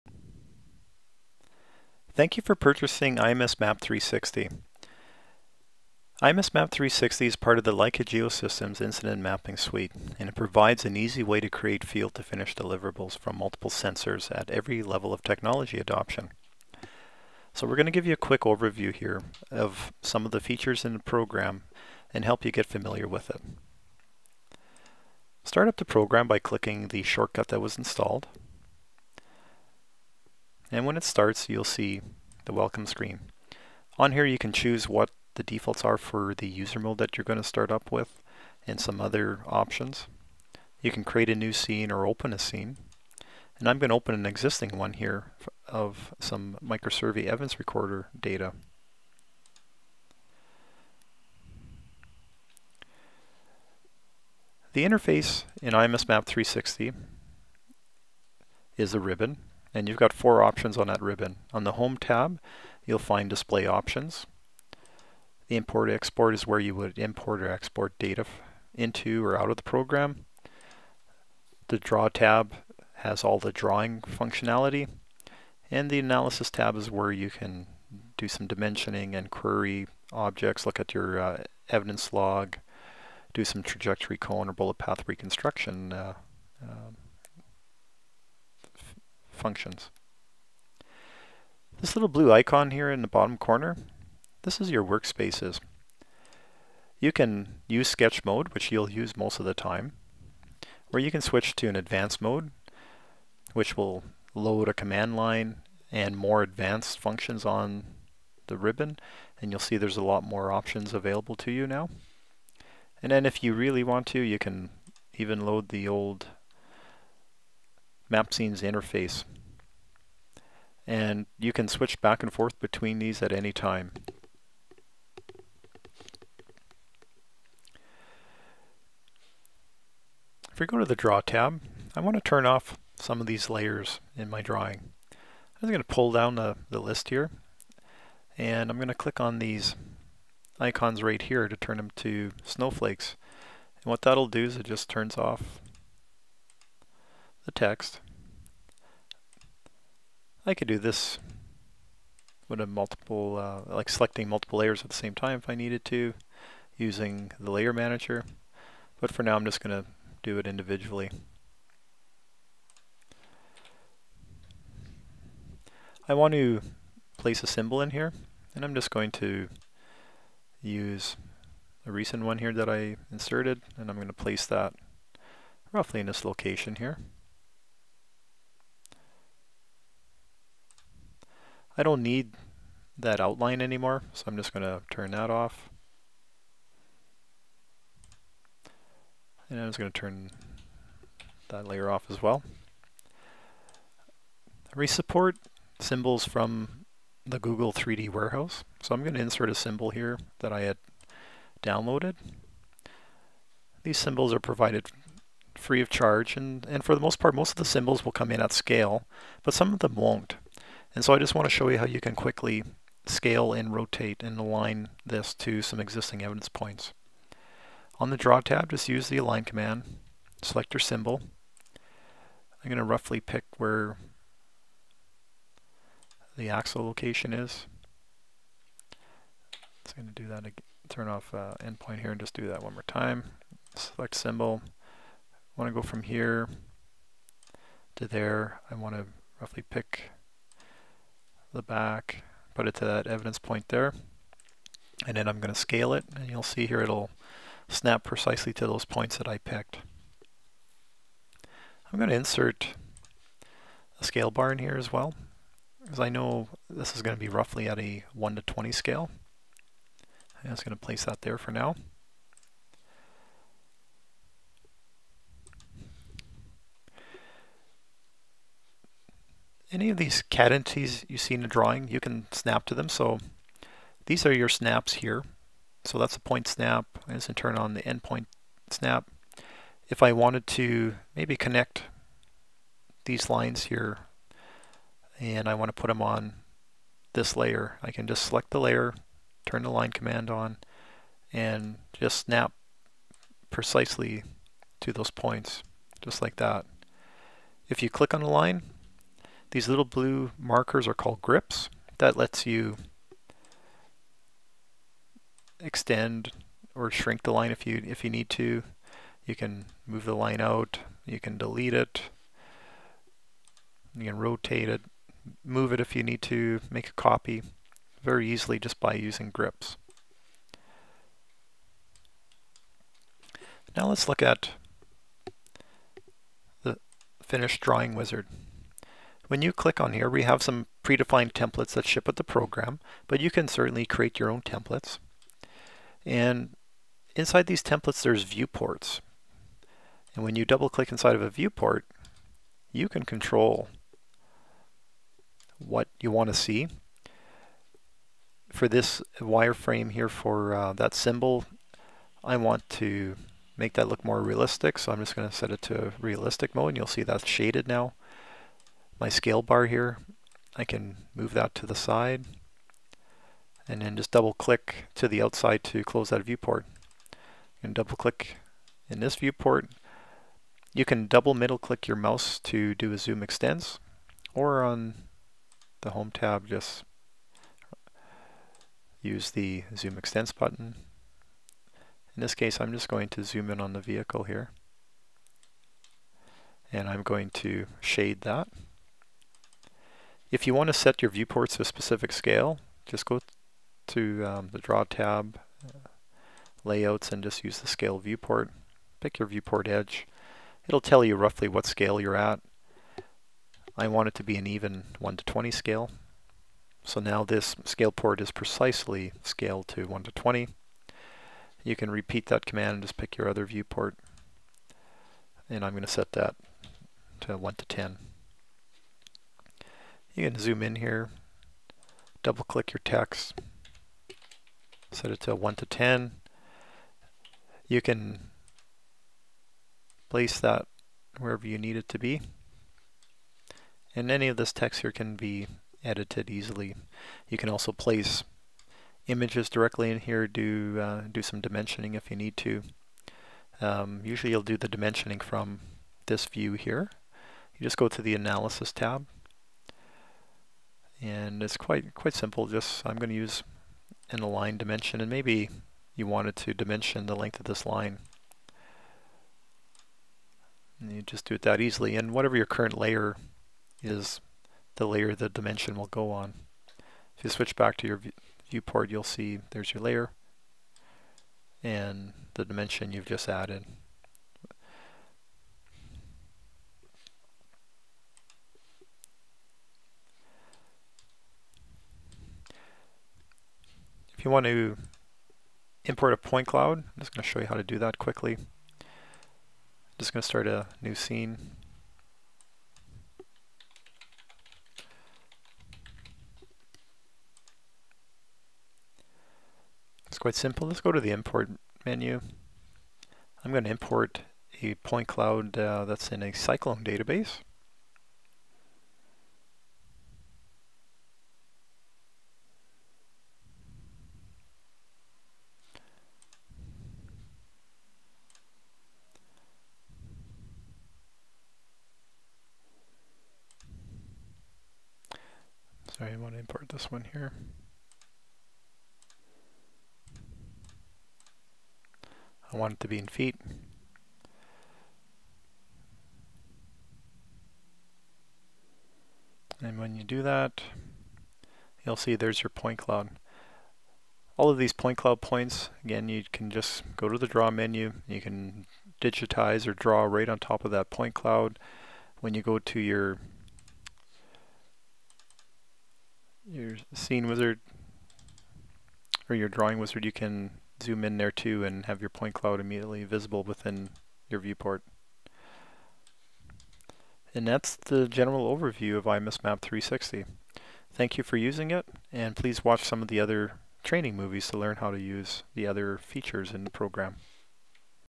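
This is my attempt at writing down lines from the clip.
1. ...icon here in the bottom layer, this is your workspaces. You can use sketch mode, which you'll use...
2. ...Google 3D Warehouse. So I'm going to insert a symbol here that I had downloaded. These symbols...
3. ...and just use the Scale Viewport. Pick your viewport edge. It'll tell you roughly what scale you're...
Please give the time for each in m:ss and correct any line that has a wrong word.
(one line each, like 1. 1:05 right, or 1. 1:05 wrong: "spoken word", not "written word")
1. 1:32 wrong: "corner", not "layer"
2. 3:17 right
3. 6:37 right.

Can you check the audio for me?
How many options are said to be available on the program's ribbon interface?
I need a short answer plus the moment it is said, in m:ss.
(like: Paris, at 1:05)
4, at 1:00.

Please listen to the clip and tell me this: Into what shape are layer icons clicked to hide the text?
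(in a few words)
snowflakes.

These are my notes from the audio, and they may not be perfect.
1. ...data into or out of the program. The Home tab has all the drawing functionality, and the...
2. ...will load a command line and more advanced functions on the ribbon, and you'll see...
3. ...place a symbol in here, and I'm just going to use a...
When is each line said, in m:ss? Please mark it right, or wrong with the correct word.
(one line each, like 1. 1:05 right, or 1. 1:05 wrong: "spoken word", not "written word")
1. 1:07 wrong: "Draw", not "Home"
2. 1:43 right
3. 2:47 right.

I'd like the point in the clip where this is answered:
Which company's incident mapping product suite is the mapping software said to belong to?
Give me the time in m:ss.
0:07.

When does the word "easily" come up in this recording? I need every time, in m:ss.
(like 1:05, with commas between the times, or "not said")
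5:18, 7:16, 7:41.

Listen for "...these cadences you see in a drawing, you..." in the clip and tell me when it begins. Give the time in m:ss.
4:29.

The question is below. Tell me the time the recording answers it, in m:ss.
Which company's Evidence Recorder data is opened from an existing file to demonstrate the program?
0:46.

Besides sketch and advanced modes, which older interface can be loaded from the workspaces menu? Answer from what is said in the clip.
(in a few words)
MapScenes.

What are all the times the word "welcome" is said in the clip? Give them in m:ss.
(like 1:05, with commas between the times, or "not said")
0:32.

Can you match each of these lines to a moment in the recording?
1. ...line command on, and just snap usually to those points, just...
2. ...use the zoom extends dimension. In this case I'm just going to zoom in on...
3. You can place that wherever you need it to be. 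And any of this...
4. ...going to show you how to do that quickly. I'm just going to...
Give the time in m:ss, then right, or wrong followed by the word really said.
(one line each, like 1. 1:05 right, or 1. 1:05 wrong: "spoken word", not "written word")
1. 4:49 wrong: "precisely", not "usually"
2. 6:19 wrong: "button", not "dimension"
3. 7:07 right
4. 8:07 right.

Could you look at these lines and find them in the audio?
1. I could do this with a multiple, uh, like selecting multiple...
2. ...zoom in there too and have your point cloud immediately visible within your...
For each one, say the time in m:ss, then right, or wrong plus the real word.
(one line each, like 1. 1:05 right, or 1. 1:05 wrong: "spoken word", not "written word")
1. 2:30 right
2. 9:20 right.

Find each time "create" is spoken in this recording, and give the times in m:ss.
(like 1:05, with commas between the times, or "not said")
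0:11, 0:41, 5:33.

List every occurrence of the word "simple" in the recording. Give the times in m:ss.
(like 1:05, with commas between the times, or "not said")
7:32, 8:20.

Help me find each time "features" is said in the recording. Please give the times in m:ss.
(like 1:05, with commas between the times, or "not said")
0:20, 9:35.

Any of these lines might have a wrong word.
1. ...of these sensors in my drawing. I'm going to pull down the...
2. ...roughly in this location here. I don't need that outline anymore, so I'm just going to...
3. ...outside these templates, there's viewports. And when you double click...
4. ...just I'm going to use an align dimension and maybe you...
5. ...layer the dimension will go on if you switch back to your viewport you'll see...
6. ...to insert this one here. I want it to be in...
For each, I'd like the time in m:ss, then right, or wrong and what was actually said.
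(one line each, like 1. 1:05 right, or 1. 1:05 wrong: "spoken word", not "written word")
1. 2:13 wrong: "layers", not "sensors"
2. 2:55 right
3. 5:37 wrong: "inside", not "outside"
4. 7:32 right
5. 7:44 right
6. 8:46 wrong: "import", not "insert".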